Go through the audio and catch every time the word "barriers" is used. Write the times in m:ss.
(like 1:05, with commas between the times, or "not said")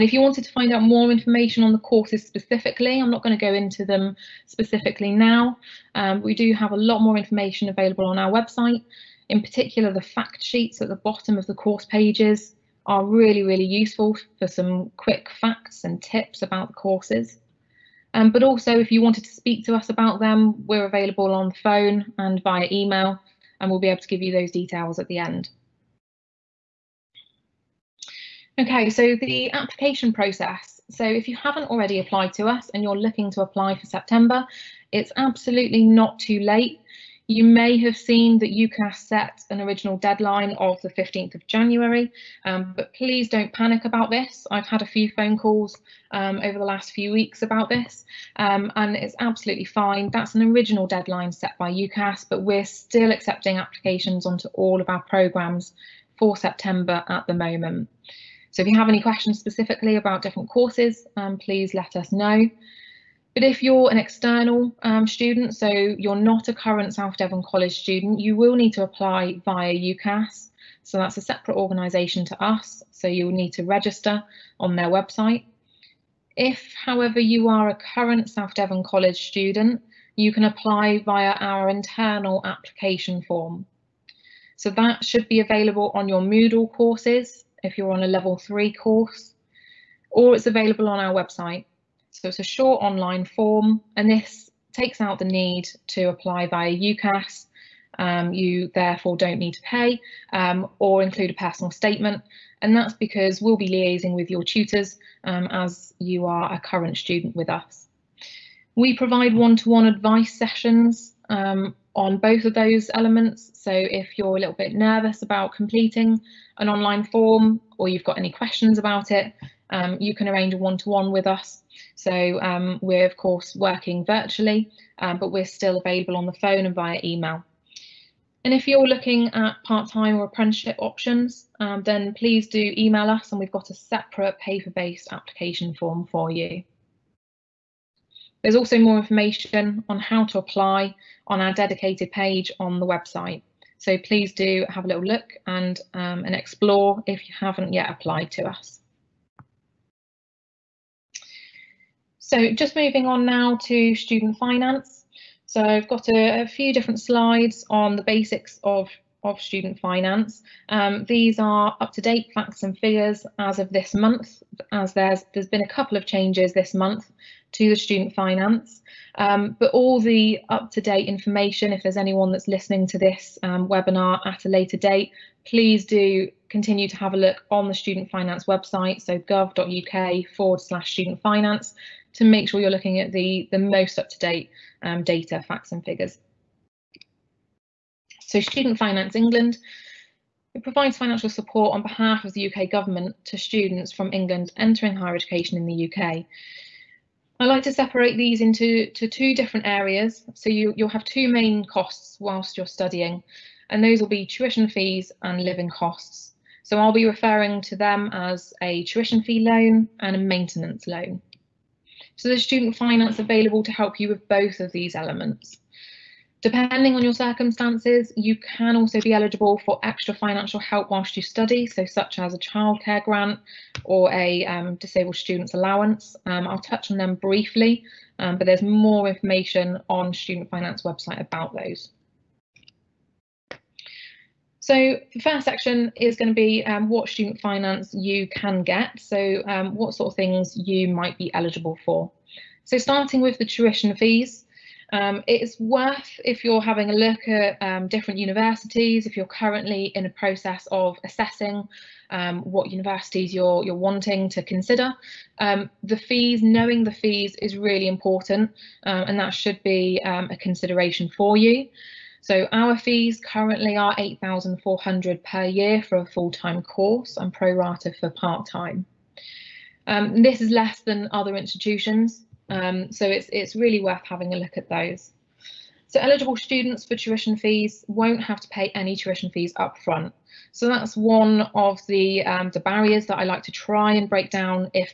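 4:42.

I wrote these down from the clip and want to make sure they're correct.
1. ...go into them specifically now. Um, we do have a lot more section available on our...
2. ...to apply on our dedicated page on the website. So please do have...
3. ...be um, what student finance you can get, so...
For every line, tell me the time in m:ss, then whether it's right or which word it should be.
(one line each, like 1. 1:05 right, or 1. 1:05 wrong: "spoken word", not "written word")
1. 0:03 wrong: "information", not "section"
2. 2:20 right
3. 3:56 right.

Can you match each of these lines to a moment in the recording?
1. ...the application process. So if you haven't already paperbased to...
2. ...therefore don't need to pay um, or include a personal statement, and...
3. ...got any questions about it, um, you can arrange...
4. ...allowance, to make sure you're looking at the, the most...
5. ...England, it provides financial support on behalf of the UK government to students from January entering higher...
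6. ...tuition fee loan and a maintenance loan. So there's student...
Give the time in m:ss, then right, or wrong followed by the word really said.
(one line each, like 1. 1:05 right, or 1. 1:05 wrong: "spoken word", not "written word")
1. 0:29 wrong: "applied", not "paperbased"
2. 1:38 right
3. 1:58 right
4. 3:01 wrong: "finance", not "allowance"
5. 3:09 wrong: "England", not "January"
6. 3:28 right.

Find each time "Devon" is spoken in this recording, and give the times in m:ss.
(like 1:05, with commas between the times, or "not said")
1:07, 1:18.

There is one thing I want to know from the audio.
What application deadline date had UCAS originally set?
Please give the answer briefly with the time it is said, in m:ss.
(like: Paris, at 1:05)
15th of January, at 0:40.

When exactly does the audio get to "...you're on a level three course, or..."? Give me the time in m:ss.
1:27.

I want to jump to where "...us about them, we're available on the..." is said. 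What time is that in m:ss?
0:19.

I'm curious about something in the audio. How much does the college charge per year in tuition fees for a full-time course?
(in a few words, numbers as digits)
8,400.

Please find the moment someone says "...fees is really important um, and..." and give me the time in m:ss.
4:16.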